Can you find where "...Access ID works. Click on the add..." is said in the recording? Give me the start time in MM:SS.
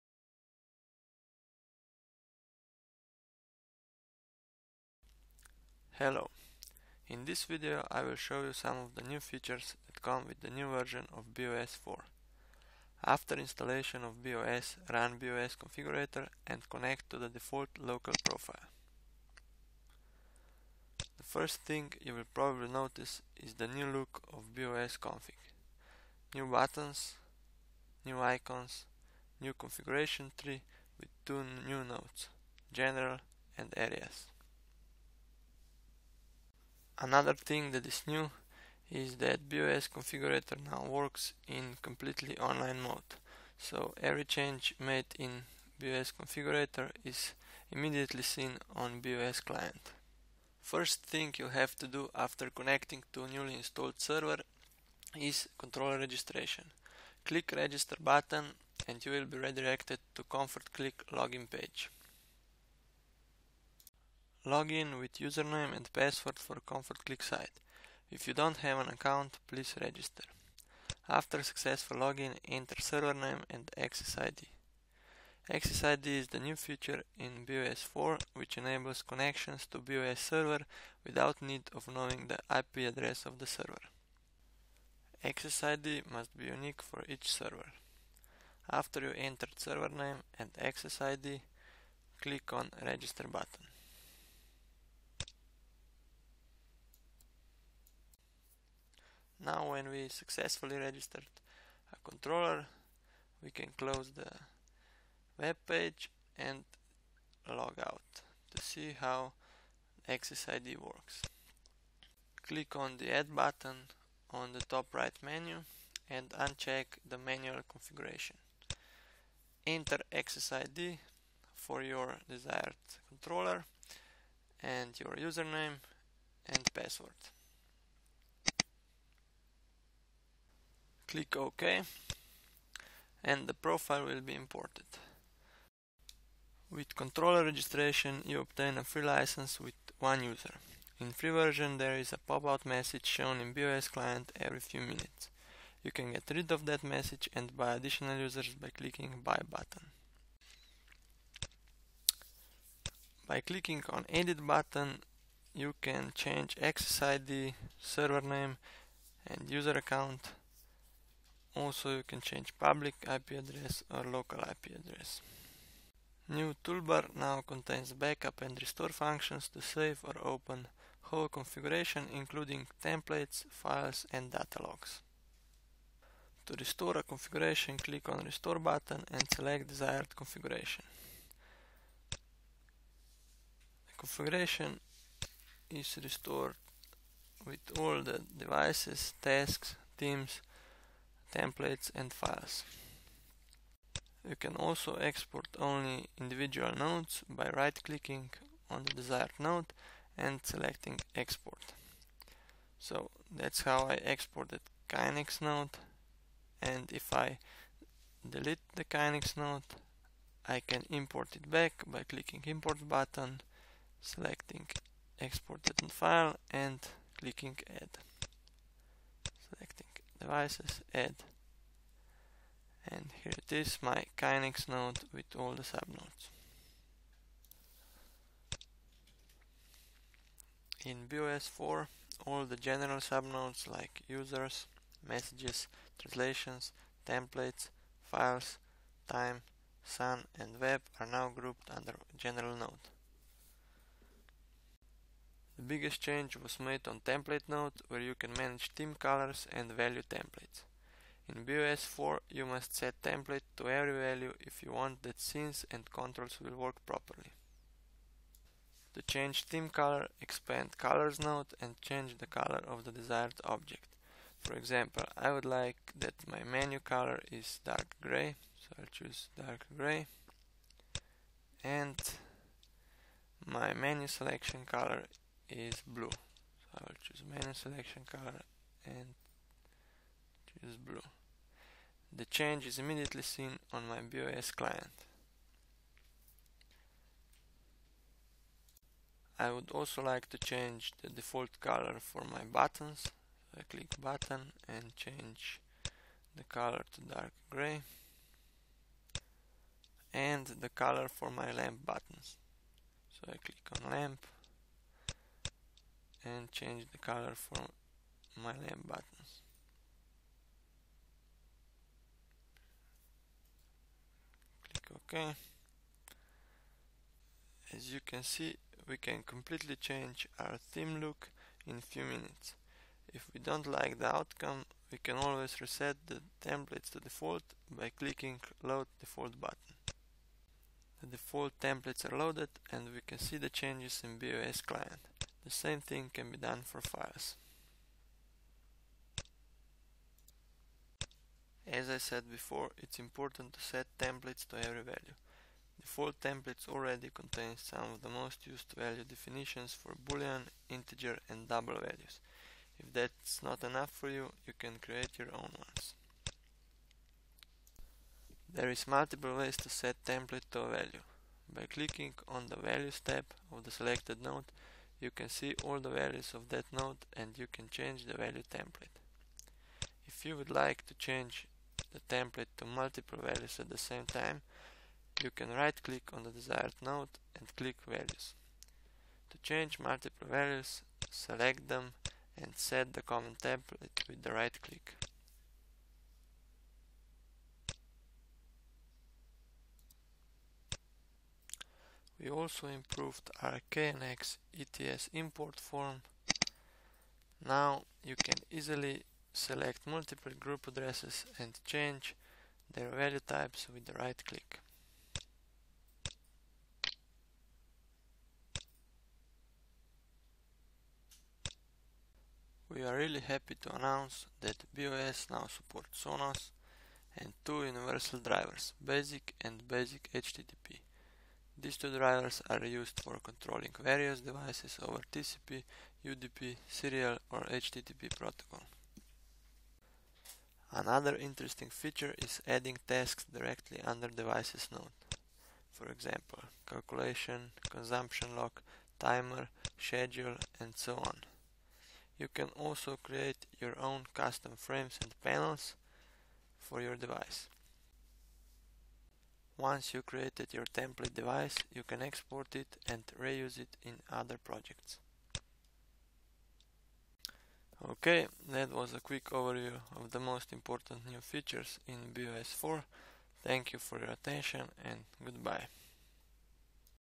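01:50.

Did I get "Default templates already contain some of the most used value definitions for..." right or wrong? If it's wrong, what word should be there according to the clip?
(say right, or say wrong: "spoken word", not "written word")
right.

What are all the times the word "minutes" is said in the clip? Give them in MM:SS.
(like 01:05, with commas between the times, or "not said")
02:24, 05:22.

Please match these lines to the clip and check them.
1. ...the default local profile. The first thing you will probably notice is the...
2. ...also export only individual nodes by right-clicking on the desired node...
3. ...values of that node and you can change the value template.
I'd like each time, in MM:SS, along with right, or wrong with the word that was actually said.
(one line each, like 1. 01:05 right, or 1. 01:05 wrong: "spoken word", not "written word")
1. 00:17 right
2. 03:14 right
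3. 06:05 right.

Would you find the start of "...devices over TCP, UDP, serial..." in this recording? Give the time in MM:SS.
07:04.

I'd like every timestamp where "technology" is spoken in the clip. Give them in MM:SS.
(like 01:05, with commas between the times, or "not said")
not said.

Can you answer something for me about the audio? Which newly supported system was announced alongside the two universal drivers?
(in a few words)
Sonos.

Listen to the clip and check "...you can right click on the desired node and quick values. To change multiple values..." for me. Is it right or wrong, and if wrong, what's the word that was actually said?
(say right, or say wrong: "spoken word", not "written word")
wrong: "click", not "quick".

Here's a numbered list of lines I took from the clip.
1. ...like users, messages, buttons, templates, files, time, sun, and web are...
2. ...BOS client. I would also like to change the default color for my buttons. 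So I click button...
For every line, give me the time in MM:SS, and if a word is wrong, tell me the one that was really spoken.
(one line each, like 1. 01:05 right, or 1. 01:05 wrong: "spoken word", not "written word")
1. 03:53 wrong: "translations", not "buttons"
2. 04:44 right.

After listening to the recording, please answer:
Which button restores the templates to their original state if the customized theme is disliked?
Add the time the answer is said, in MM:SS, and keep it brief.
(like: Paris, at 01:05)
Load Default, at 05:28.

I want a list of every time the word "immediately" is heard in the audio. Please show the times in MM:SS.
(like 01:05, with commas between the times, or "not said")
00:47, 04:42.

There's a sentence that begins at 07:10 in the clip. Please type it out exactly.
Another interesting feature is adding tasks directly under devices node.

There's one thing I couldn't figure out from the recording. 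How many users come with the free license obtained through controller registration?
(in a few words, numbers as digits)
1.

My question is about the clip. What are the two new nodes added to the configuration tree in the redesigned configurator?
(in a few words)
General and areas.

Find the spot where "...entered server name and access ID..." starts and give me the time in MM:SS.
01:29.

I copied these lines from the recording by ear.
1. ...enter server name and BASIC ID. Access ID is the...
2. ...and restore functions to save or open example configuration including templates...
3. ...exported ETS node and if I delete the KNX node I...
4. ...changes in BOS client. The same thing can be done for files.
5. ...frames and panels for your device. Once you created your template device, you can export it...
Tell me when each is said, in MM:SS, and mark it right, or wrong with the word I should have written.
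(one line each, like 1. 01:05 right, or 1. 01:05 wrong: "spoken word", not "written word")
1. 01:12 wrong: "Access", not "BASIC"
2. 02:48 wrong: "whole", not "example"
3. 03:23 wrong: "KNX", not "ETS"
4. 05:33 right
5. 07:24 right.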